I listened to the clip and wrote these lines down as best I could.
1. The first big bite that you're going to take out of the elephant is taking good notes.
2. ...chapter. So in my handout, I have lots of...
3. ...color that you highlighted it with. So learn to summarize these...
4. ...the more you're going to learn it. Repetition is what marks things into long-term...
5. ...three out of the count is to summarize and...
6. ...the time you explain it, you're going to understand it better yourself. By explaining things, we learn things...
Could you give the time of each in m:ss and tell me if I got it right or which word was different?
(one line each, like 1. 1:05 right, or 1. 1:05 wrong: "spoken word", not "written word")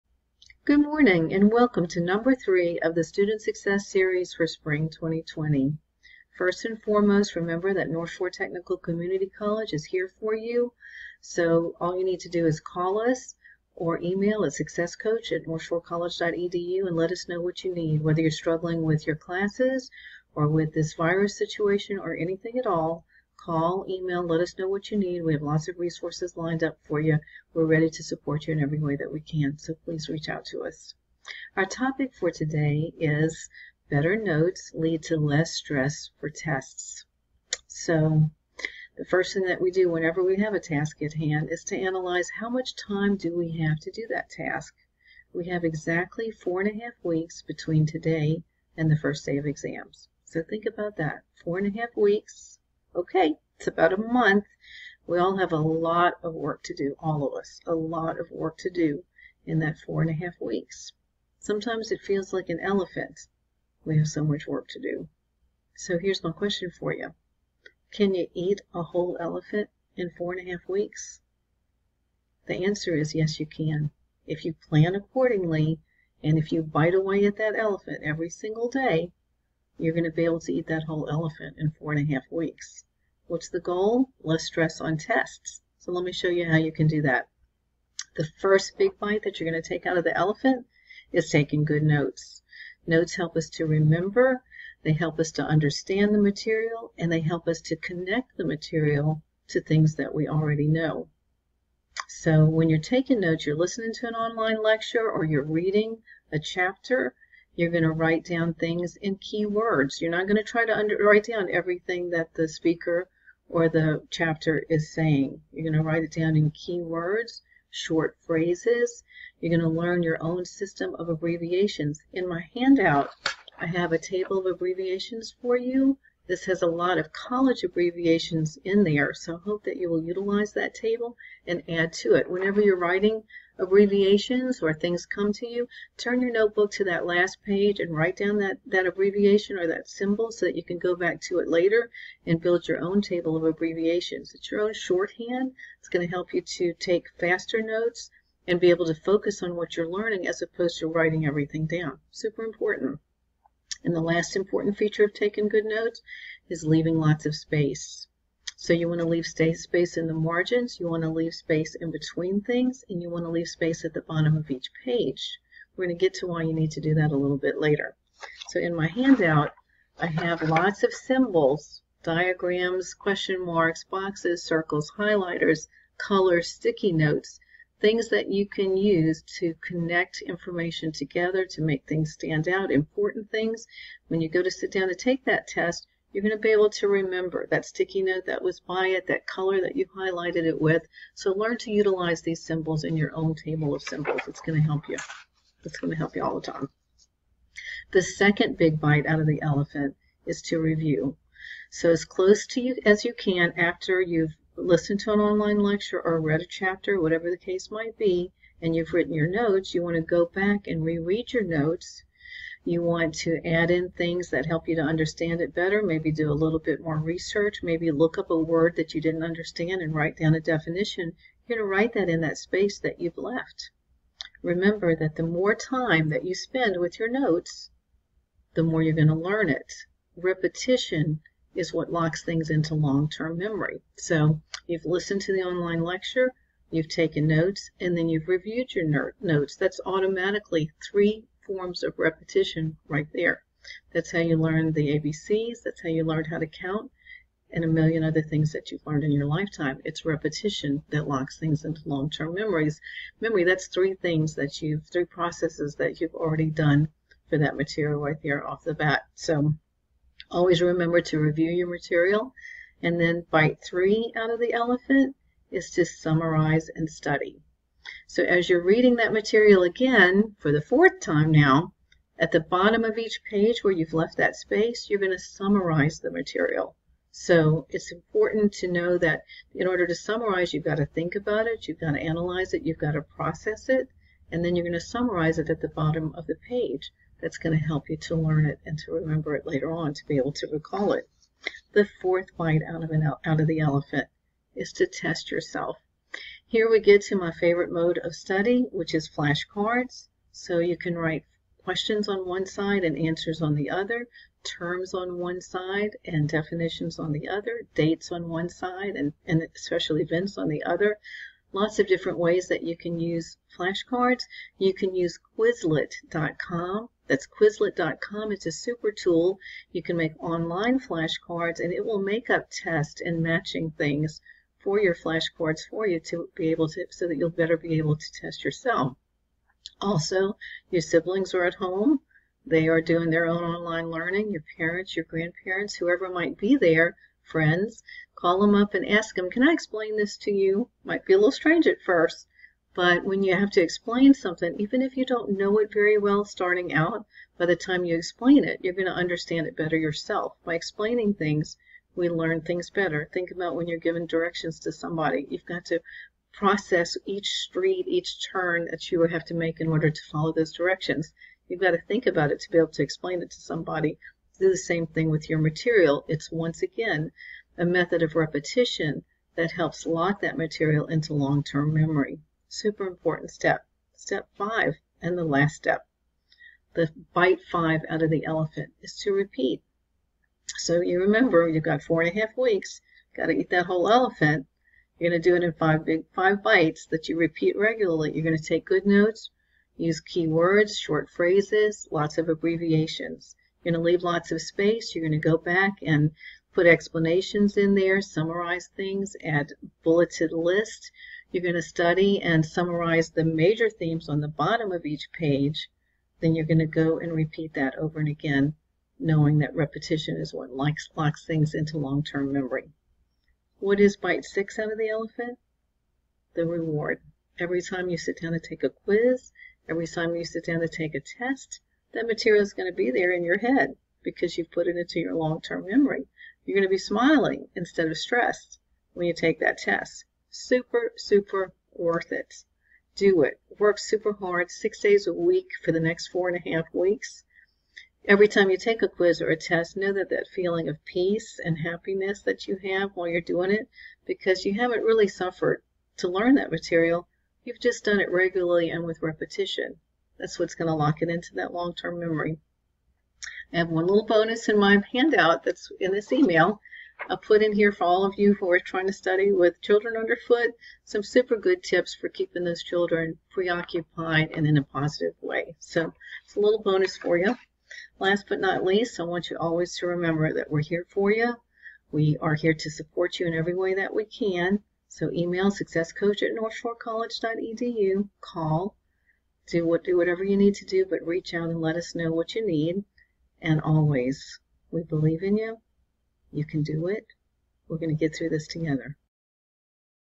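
1. 1:28 right
2. 2:47 wrong: "later", not "chapter"
3. 3:09 wrong: "utilize", not "summarize"
4. 3:48 wrong: "locks", not "marks"
5. 4:23 wrong: "elephant", not "count"
6. 5:47 right.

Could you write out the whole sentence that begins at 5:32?
They are doing their own online learning.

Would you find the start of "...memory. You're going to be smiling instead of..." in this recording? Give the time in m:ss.
7:05.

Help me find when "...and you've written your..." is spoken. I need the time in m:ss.
3:28.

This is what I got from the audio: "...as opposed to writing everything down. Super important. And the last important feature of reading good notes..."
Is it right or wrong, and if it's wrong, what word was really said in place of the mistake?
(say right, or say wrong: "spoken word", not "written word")
wrong: "taking", not "reading".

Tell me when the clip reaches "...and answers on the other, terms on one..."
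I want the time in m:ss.
5:02.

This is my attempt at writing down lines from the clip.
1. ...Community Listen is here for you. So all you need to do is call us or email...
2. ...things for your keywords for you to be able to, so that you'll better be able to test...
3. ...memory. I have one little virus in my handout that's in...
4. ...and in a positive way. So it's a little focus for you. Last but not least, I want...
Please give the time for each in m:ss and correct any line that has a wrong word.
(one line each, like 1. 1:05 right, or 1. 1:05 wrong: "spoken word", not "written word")
1. 0:08 wrong: "College", not "Listen"
2. 5:23 wrong: "flashcards", not "keywords"
3. 7:31 wrong: "bonus", not "virus"
4. 7:44 wrong: "bonus", not "focus".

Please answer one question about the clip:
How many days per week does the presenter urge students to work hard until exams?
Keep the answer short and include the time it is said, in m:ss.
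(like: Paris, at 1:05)
6, at 7:14.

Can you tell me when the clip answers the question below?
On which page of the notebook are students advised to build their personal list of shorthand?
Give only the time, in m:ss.
2:17.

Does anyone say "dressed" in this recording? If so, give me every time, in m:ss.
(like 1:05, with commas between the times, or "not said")
not said.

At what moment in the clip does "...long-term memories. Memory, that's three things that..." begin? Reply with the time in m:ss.
4:11.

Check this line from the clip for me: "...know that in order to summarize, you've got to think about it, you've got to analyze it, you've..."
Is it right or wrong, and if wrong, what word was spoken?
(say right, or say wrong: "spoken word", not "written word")
right.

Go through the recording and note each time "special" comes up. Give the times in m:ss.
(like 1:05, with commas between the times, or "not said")
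5:09.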